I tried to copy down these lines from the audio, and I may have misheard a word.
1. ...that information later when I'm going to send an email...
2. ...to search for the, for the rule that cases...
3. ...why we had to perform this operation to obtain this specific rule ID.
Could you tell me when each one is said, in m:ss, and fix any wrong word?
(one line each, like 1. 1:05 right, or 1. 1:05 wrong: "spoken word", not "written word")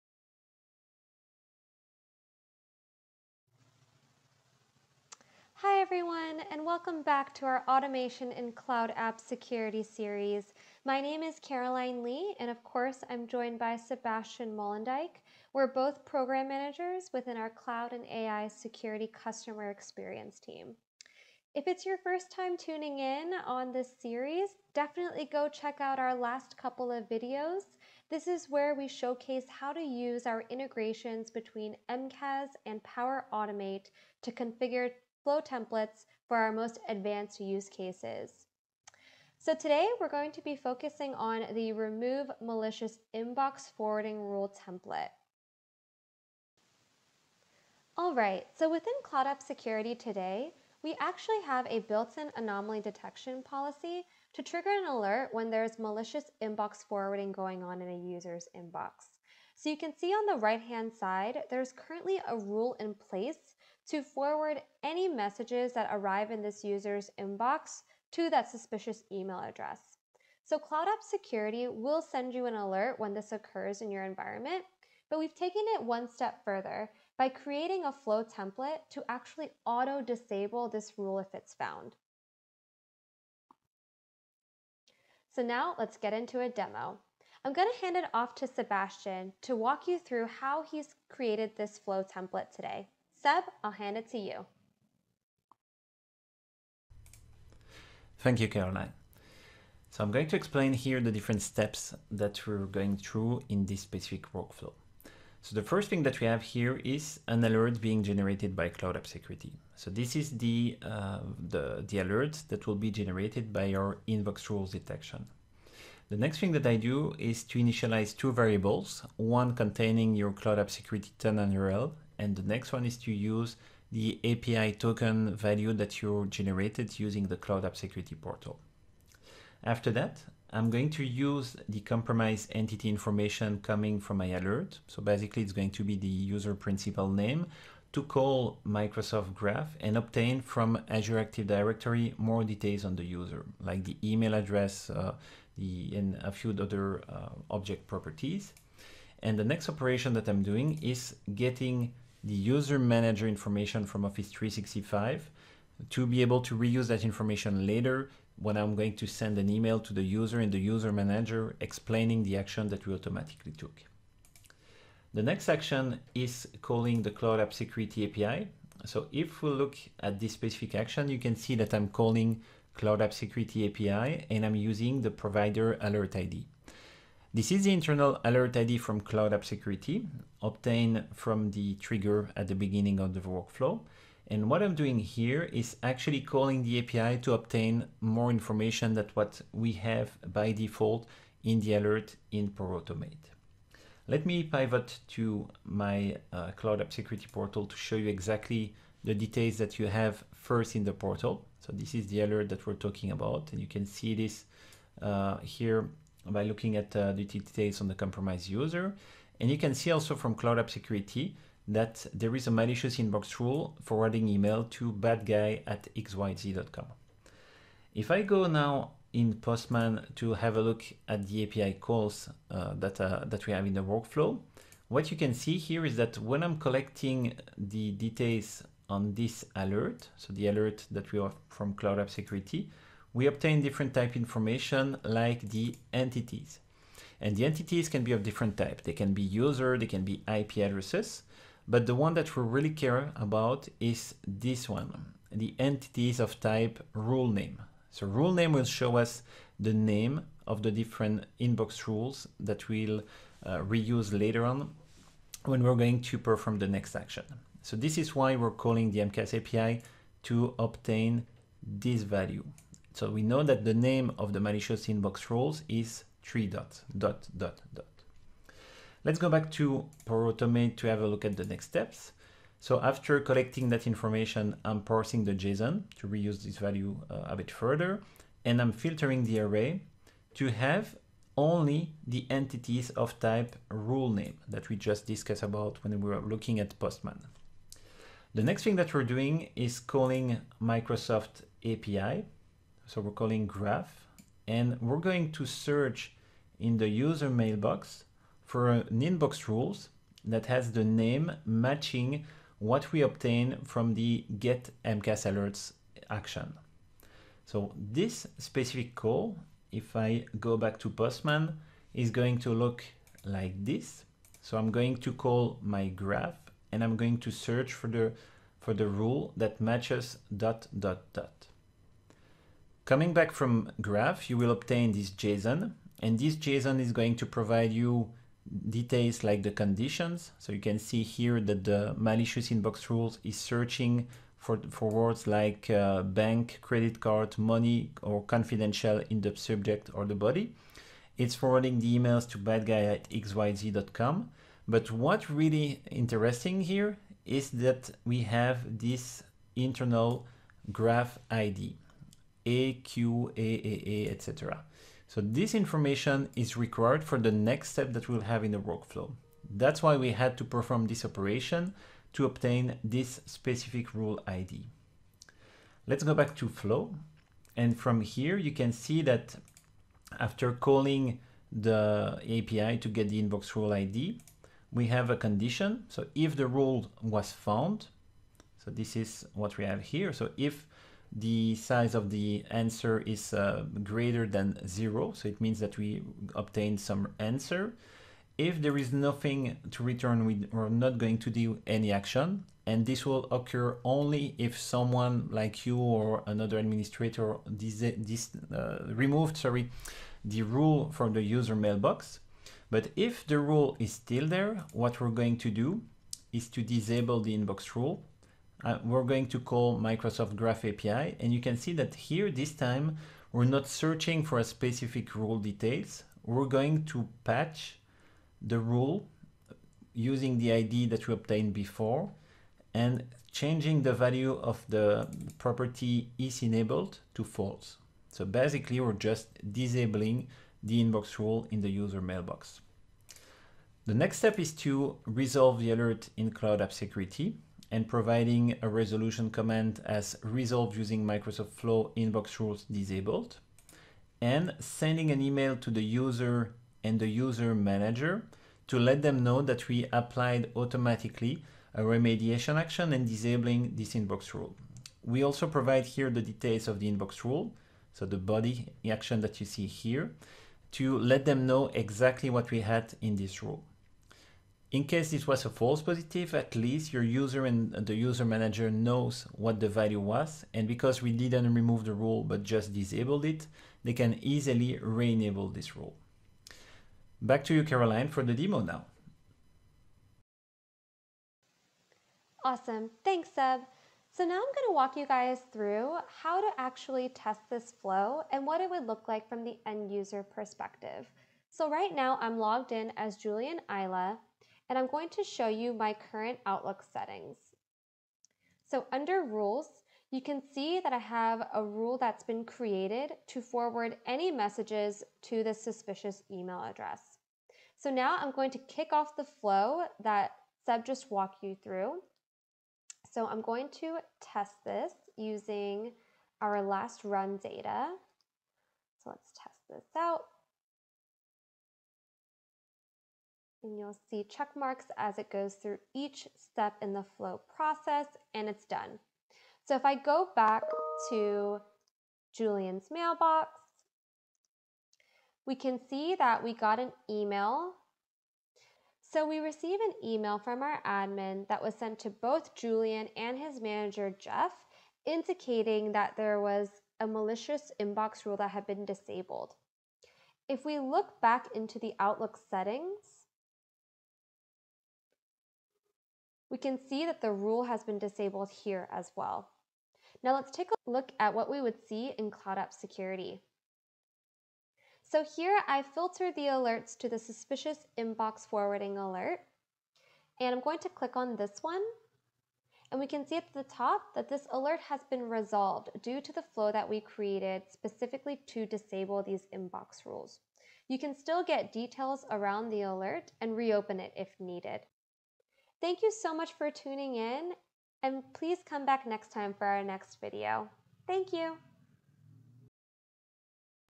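1. 2:36 right
2. 5:17 wrong: "matches", not "cases"
3. 5:59 right.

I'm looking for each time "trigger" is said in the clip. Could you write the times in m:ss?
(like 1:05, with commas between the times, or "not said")
0:54, 3:01.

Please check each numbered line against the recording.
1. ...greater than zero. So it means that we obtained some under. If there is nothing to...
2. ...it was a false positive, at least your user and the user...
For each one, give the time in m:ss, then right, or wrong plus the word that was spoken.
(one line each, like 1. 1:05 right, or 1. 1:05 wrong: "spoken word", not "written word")
1. 6:23 wrong: "answer", not "under"
2. 7:45 right.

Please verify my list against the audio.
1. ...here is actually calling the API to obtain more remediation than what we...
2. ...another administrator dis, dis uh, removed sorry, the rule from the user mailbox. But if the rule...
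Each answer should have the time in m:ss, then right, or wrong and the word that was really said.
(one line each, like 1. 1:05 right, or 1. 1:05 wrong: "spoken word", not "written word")
1. 3:04 wrong: "information", not "remediation"
2. 6:36 right.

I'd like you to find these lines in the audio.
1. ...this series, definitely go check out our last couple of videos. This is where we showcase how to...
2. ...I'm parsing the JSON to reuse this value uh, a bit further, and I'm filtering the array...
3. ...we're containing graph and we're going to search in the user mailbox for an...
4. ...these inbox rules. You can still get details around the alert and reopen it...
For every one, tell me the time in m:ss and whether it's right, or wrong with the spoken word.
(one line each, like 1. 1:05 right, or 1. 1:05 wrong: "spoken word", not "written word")
1. 0:23 right
2. 4:34 right
3. 4:52 wrong: "calling", not "containing"
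4. 9:39 right.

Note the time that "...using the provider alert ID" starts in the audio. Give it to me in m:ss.
2:54.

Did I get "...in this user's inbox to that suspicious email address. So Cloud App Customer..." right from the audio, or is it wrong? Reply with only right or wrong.
wrong.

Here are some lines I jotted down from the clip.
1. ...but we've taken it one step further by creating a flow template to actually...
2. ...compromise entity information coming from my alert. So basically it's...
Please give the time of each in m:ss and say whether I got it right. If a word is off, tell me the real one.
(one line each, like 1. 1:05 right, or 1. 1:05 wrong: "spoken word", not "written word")
1. 1:15 right
2. 2:11 right.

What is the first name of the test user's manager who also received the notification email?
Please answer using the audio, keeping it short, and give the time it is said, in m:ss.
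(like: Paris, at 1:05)
Jeff, at 9:04.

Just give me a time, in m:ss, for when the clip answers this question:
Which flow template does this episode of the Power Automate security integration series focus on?
0:41.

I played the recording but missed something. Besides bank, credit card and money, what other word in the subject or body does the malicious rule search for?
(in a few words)
Confidential.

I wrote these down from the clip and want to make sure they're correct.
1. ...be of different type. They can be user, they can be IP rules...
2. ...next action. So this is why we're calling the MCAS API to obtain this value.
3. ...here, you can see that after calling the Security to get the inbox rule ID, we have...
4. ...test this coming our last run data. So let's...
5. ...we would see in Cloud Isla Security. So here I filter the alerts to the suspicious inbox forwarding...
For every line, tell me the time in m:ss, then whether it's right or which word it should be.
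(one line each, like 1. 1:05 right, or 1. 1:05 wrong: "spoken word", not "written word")
1. 3:58 wrong: "addresses", not "rules"
2. 4:16 right
3. 6:08 wrong: "API", not "Security"
4. 8:34 wrong: "using", not "coming"
5. 9:21 wrong: "App", not "Isla".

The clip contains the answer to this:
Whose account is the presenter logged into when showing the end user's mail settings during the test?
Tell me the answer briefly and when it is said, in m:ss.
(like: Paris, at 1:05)
Julian Isla, at 8:13.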